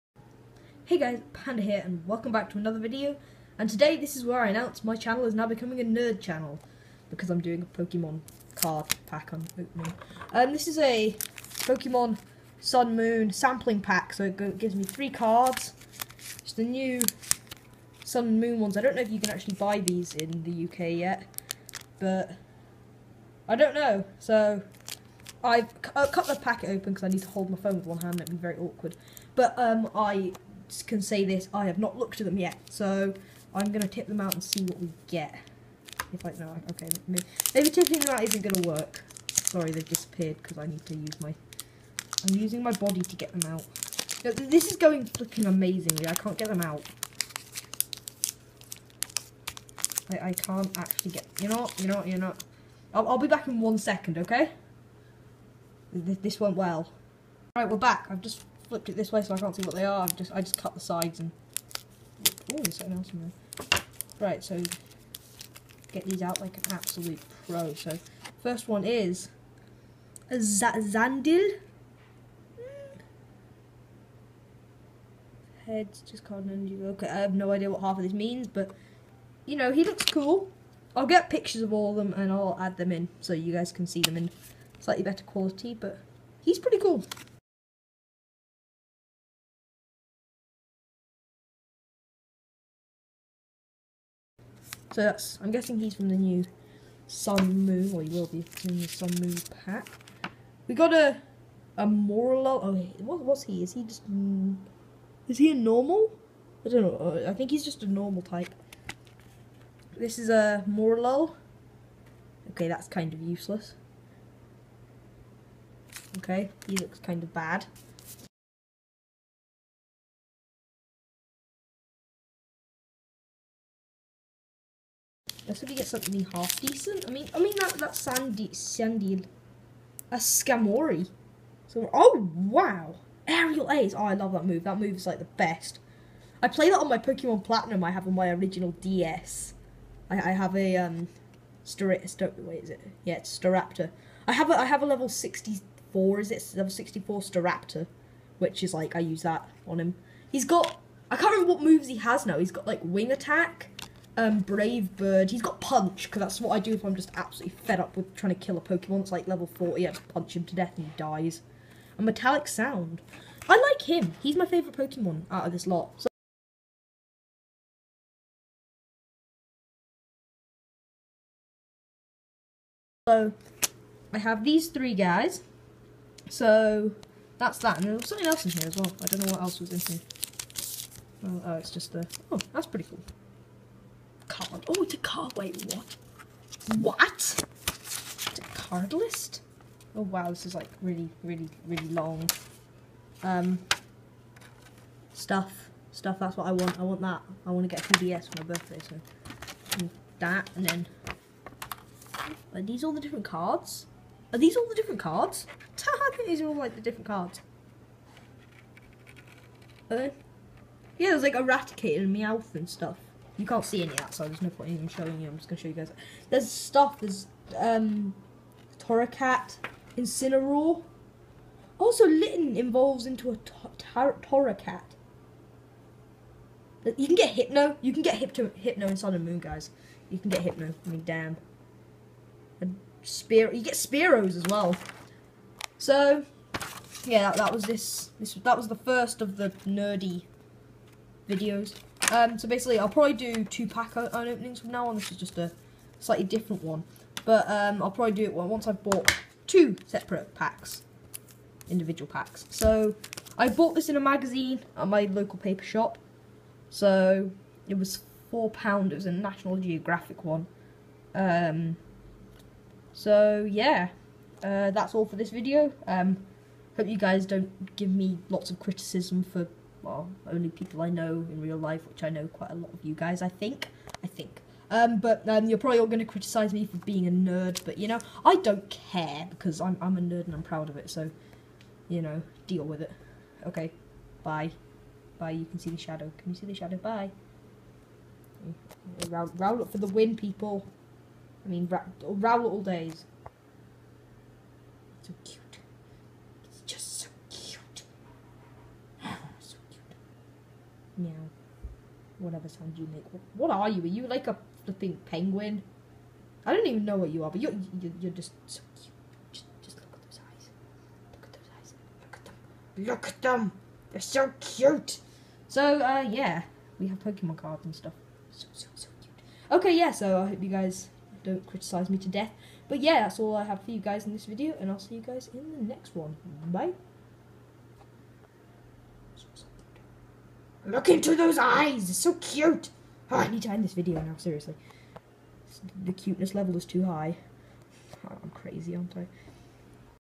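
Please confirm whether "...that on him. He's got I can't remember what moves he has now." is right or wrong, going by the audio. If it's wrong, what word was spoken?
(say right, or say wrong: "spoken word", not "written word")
right.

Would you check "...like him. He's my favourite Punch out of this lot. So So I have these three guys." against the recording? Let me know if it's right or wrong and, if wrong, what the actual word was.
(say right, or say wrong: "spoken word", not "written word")
wrong: "Pokemon", not "Punch".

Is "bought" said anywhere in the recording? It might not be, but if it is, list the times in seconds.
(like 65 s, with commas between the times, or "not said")
248 s, 253 s.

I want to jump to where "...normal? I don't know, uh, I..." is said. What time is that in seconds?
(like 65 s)
105 s.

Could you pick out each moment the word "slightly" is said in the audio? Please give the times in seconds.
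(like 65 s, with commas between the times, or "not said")
84 s, 246 s.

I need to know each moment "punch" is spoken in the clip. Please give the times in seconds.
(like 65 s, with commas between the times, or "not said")
155 s, 160 s.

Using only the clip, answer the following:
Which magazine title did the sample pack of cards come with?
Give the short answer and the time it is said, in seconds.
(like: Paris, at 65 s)
National Geographic, at 259 s.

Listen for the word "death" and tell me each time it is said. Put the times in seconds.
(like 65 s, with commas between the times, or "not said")
160 s, 322 s.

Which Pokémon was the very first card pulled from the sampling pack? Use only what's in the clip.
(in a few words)
Sandile.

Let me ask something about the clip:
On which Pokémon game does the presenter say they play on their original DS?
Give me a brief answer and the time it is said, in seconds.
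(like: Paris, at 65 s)
Pokemon Platinum, at 136 s.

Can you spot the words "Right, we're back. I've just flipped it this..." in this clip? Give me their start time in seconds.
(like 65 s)
57 s.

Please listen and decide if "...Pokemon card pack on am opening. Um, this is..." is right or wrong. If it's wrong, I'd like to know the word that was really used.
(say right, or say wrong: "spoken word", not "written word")
right.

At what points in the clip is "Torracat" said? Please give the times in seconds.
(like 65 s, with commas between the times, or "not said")
218 s, 223 s.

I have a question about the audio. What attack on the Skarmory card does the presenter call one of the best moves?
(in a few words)
Aerial Ace.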